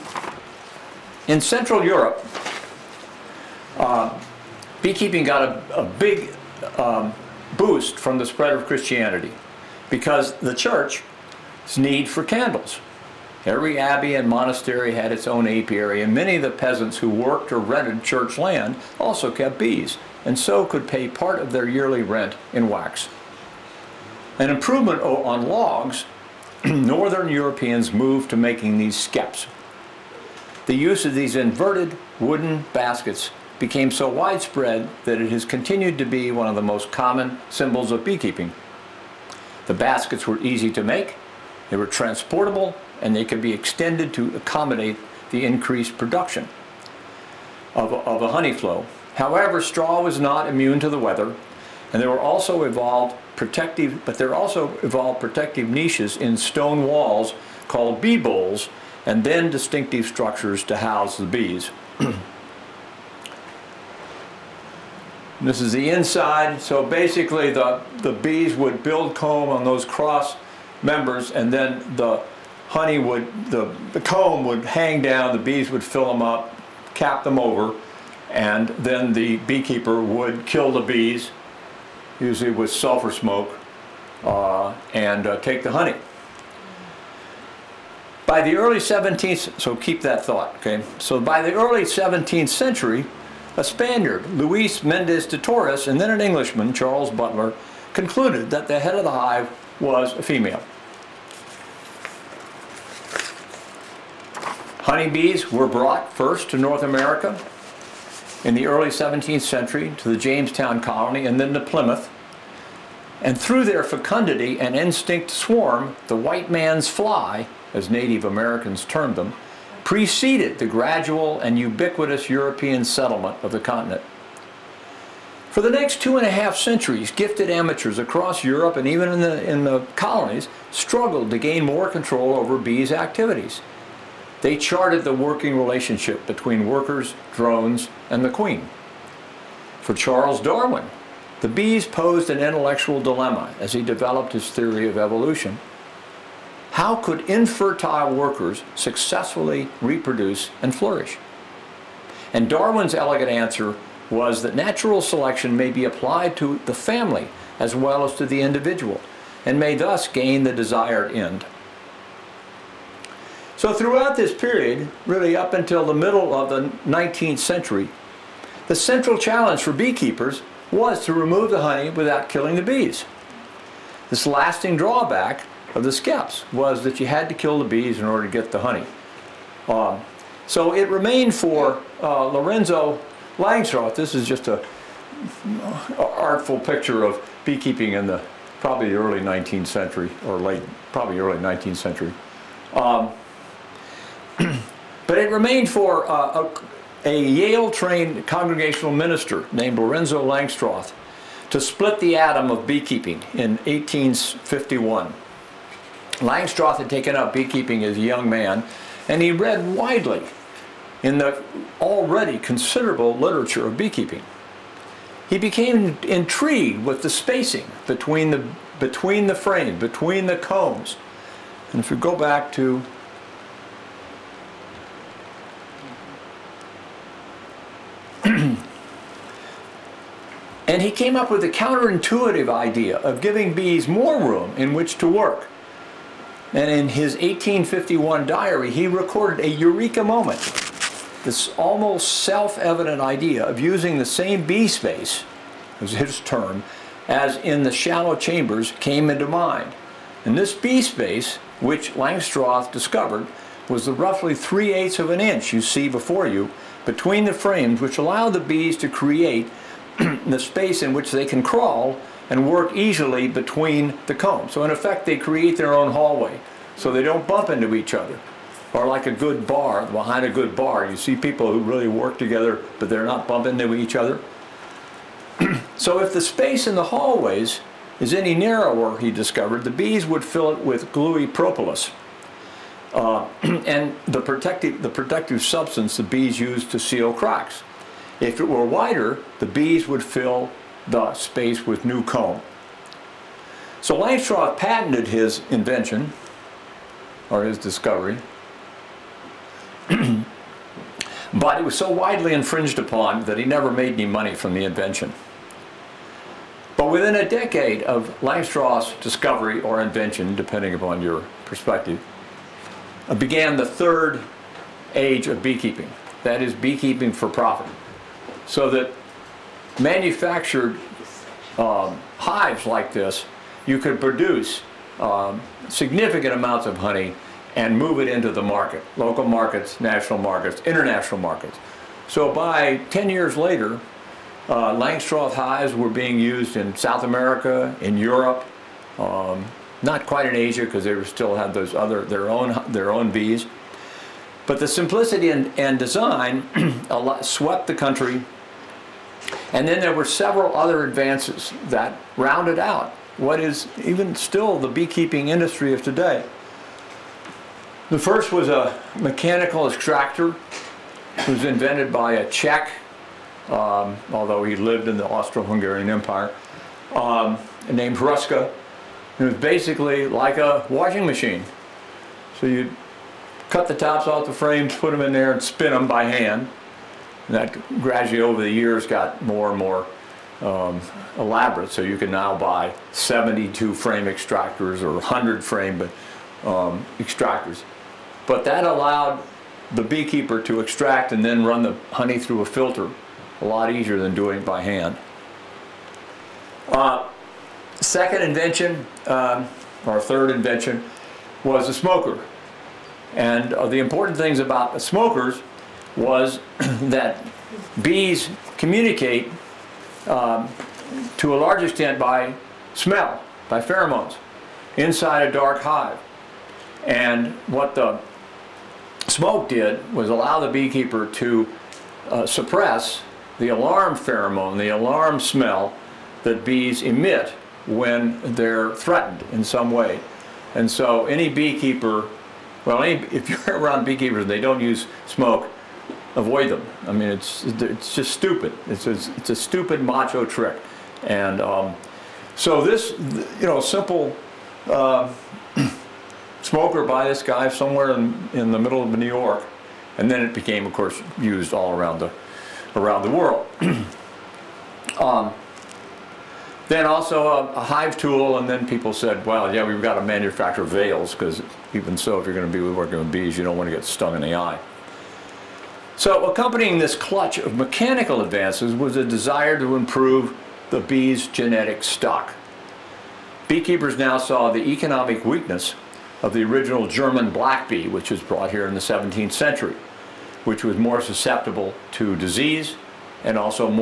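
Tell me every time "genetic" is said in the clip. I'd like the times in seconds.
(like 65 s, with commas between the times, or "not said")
471 s.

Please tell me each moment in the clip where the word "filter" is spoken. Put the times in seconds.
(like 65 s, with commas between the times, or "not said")
392 s.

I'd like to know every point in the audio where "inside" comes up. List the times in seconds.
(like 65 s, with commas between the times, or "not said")
65 s, 414 s.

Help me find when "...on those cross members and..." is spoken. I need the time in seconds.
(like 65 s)
69 s.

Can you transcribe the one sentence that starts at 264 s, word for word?
So in effect, they create their own hallway so they don't bump into each other.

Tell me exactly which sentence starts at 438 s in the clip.
It's, it's, it's a stupid macho trick.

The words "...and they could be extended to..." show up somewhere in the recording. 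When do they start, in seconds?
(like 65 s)
42 s.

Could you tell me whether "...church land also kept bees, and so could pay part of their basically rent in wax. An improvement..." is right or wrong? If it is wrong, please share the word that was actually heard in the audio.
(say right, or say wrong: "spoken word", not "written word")
wrong: "yearly", not "basically".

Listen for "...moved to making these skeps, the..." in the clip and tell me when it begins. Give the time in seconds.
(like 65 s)
27 s.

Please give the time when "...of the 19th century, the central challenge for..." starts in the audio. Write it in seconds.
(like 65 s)
166 s.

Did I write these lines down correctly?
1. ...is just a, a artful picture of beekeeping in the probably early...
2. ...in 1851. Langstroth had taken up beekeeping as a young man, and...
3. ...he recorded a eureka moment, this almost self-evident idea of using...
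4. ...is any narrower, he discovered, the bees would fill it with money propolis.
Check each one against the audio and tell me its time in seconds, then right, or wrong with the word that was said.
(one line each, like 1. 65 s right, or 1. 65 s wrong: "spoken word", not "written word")
1. 184 s right
2. 203 s right
3. 238 s right
4. 277 s wrong: "gluey", not "money".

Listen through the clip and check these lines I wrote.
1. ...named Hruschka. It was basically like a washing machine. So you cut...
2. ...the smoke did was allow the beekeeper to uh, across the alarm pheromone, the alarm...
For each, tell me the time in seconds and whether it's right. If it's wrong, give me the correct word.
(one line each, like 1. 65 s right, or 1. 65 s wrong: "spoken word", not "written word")
1. 367 s right
2. 417 s wrong: "suppress", not "across".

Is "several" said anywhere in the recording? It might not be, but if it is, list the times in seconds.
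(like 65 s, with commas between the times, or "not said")
350 s.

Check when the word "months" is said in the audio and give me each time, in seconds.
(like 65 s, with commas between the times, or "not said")
not said.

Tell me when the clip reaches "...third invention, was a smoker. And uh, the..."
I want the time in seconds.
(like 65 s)
399 s.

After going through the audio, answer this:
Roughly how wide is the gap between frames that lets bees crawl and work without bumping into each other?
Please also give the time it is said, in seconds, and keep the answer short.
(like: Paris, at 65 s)
3/8 of an inch, at 254 s.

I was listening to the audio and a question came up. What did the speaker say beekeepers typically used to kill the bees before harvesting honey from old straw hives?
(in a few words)
sulfur smoke.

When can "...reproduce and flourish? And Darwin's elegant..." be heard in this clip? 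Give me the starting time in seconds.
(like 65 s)
149 s.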